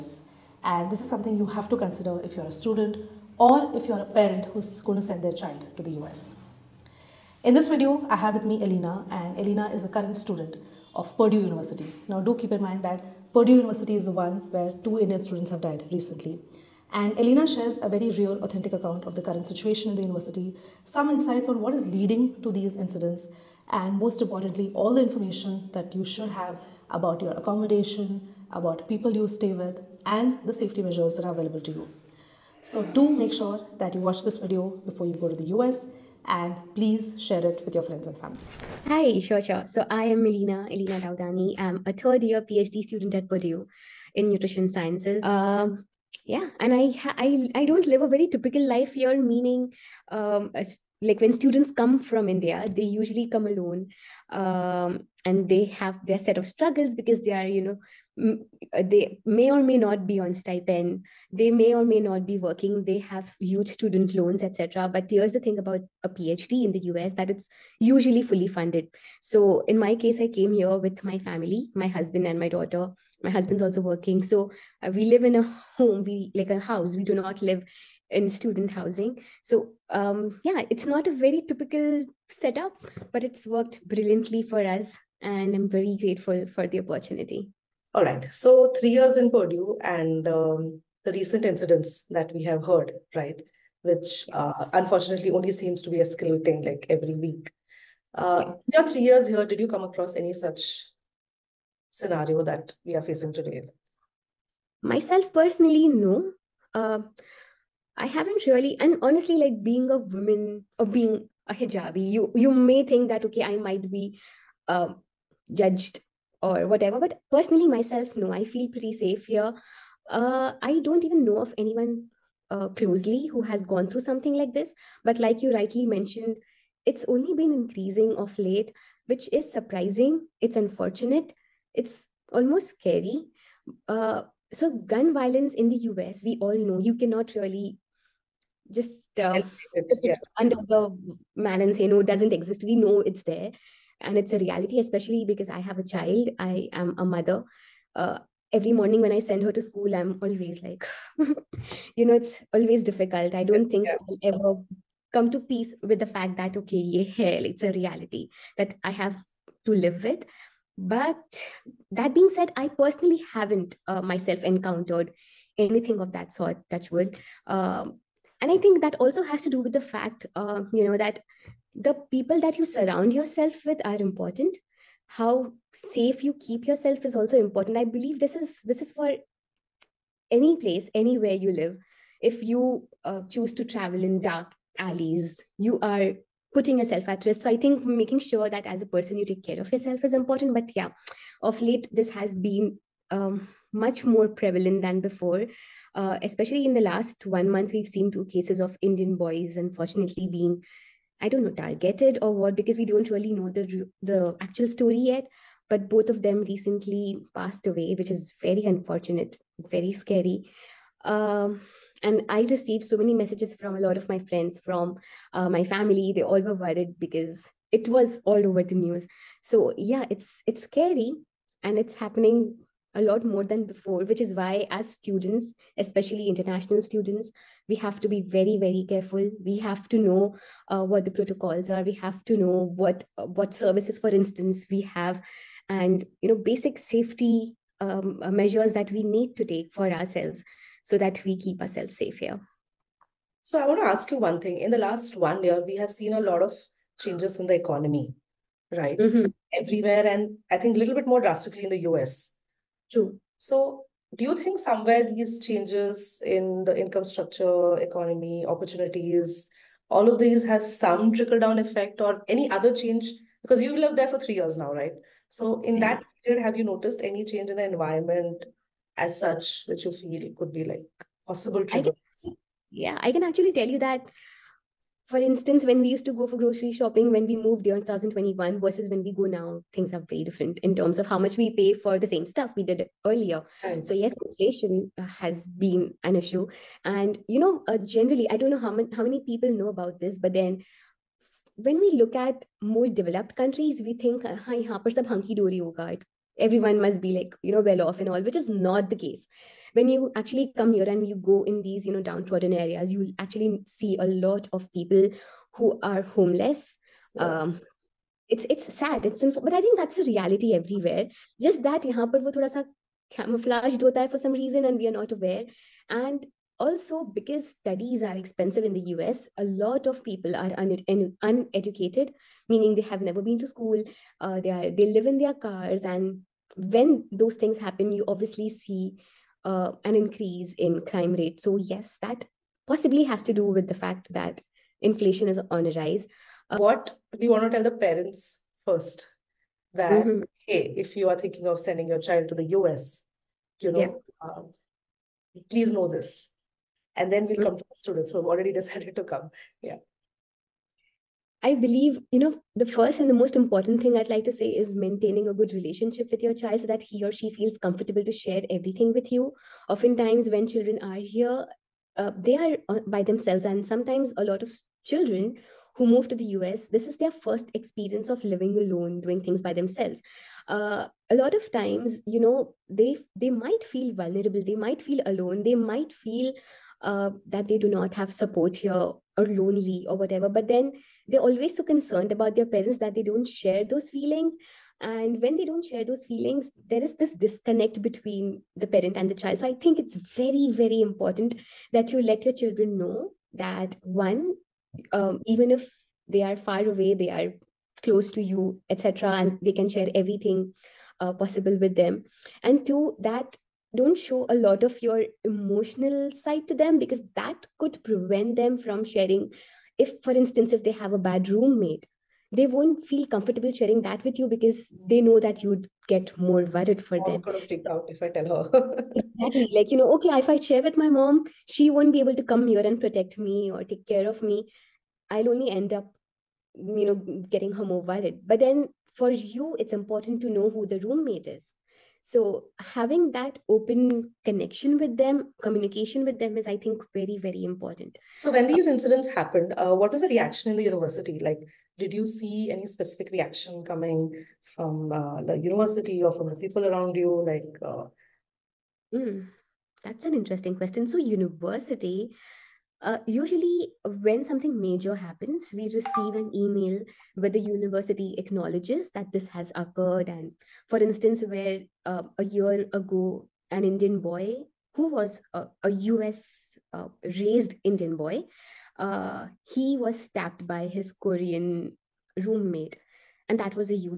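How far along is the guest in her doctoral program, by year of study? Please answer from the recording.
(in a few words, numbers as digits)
Third year.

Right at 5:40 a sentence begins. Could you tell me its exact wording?
hey if you are thinking of sending your child to the us you know yeah.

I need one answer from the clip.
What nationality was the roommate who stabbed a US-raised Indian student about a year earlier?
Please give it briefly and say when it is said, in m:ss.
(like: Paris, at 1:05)
Korean, at 7:50.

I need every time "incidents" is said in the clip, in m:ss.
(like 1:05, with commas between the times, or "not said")
0:22, 1:31, 7:18.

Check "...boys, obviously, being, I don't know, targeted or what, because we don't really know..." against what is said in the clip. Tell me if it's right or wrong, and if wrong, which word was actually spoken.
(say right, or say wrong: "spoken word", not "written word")
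wrong: "unfortunately", not "obviously".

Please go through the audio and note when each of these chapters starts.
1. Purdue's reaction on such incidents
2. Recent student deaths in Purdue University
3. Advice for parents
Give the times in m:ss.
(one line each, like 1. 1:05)
1. 7:18
2. 1:28
3. 5:36.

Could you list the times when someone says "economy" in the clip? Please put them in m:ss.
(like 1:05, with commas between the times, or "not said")
4:07, 4:17.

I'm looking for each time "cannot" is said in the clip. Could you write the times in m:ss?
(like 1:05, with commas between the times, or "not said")
2:16.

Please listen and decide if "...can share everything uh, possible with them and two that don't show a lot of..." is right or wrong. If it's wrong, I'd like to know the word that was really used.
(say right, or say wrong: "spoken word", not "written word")
right.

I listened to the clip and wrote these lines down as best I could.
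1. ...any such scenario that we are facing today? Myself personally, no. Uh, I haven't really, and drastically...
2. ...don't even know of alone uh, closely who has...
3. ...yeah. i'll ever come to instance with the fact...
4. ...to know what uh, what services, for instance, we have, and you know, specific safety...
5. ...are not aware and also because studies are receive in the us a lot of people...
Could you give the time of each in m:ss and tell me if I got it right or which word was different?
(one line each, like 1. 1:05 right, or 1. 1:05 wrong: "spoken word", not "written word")
1. 1:40 wrong: "honestly", not "drastically"
2. 2:00 wrong: "anyone", not "alone"
3. 2:33 wrong: "peace", not "instance"
4. 3:52 wrong: "basic", not "specific"
5. 5:14 wrong: "expensive", not "receive".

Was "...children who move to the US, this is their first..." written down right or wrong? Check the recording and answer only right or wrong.
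right.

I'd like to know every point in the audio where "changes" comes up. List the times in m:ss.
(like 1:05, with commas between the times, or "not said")
4:06, 4:15, 4:22, 4:27.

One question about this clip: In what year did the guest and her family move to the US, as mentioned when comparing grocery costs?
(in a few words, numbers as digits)
2021.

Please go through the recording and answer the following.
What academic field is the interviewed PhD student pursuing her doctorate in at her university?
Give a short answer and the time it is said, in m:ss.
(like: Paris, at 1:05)
Nutrition sciences, at 0:44.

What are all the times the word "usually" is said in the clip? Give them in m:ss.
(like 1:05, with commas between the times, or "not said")
0:52, 1:07, 7:33.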